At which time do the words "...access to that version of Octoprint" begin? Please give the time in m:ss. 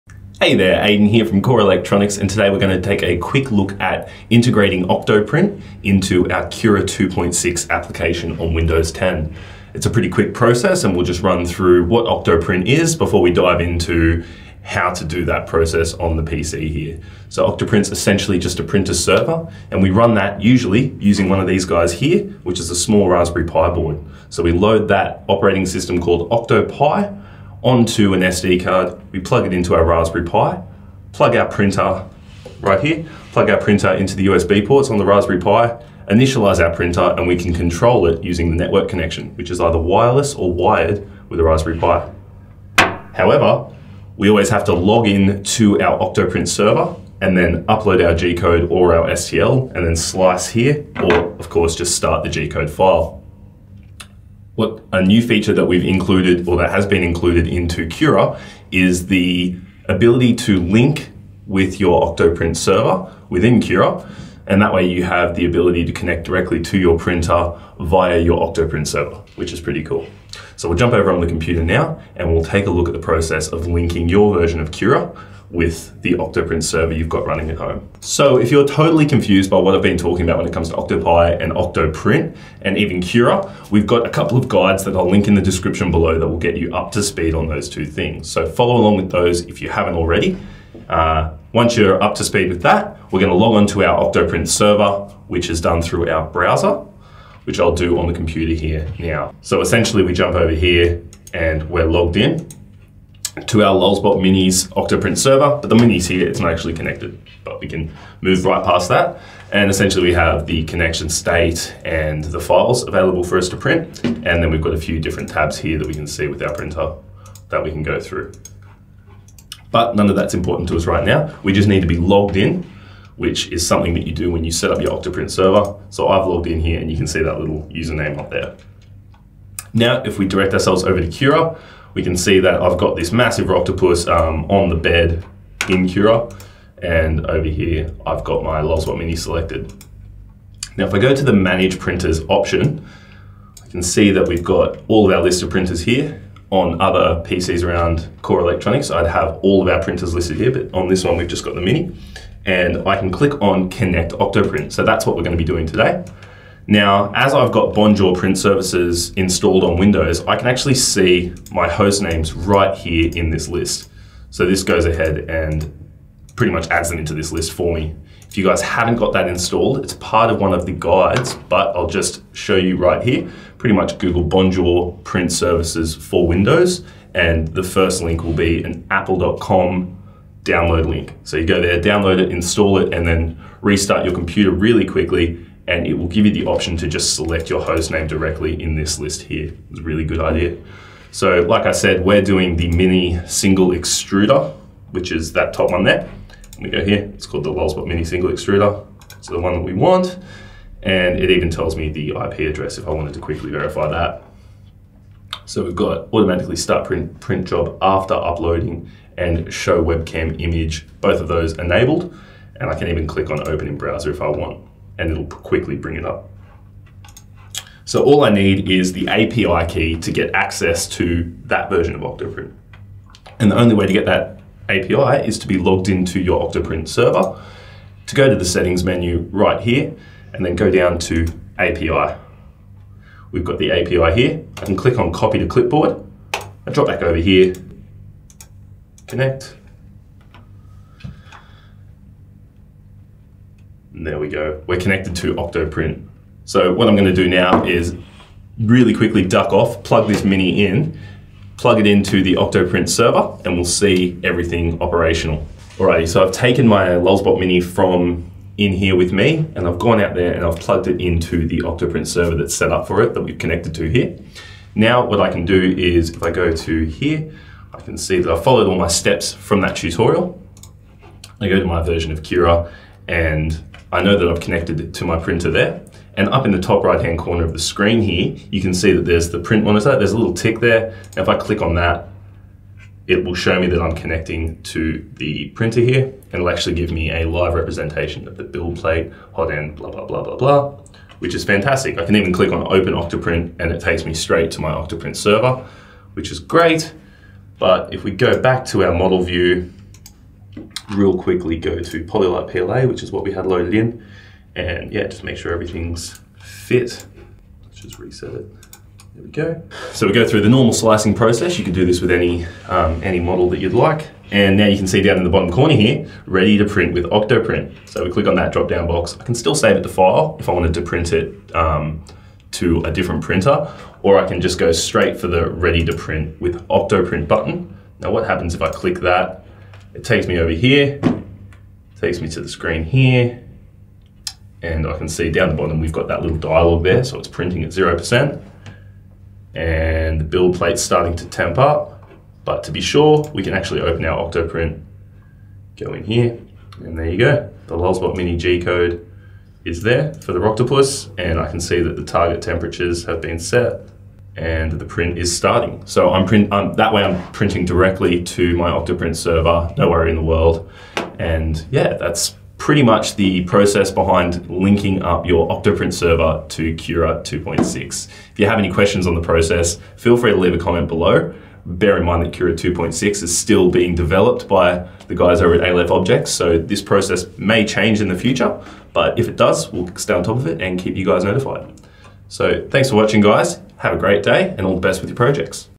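3:40.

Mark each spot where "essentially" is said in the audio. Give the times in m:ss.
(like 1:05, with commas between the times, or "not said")
0:17, 1:39, 1:49.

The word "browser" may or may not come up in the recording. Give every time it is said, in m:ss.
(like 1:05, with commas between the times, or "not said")
1:36, 3:33.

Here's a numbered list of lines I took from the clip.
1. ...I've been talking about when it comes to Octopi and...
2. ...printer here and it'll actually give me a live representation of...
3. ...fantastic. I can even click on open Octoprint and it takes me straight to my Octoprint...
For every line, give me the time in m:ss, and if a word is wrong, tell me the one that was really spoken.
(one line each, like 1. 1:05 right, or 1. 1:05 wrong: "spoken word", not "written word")
1. 1:19 right
2. 4:45 right
3. 4:51 right.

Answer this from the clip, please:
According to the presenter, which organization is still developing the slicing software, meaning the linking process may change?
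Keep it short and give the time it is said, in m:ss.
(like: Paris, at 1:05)
Aleph Objects, at 6:15.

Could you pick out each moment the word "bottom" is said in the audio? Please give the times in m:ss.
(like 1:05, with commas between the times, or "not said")
5:15, 5:35.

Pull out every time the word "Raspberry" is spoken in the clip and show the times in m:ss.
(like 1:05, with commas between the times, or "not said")
0:23, 0:29, 0:35, 0:41.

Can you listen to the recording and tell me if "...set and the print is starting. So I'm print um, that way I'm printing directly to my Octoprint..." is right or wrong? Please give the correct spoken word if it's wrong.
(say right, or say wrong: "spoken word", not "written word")
right.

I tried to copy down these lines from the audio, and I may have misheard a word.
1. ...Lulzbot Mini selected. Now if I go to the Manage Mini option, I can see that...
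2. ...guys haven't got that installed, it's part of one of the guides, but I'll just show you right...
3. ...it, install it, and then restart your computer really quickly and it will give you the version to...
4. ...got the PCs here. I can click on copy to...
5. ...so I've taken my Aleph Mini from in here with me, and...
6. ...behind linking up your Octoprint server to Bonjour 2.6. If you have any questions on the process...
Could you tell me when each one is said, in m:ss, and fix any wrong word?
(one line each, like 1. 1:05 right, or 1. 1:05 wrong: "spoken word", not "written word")
1. 2:18 wrong: "Printers", not "Mini"
2. 2:48 right
3. 3:02 wrong: "option", not "version"
4. 3:53 wrong: "API", not "PCs"
5. 4:16 wrong: "Lulzbot", not "Aleph"
6. 6:03 wrong: "Cura", not "Bonjour".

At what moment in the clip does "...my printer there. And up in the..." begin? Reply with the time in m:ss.
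4:35.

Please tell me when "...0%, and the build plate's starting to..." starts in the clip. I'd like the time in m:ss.
5:37.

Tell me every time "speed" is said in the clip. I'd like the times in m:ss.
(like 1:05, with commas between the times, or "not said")
1:27, 1:32.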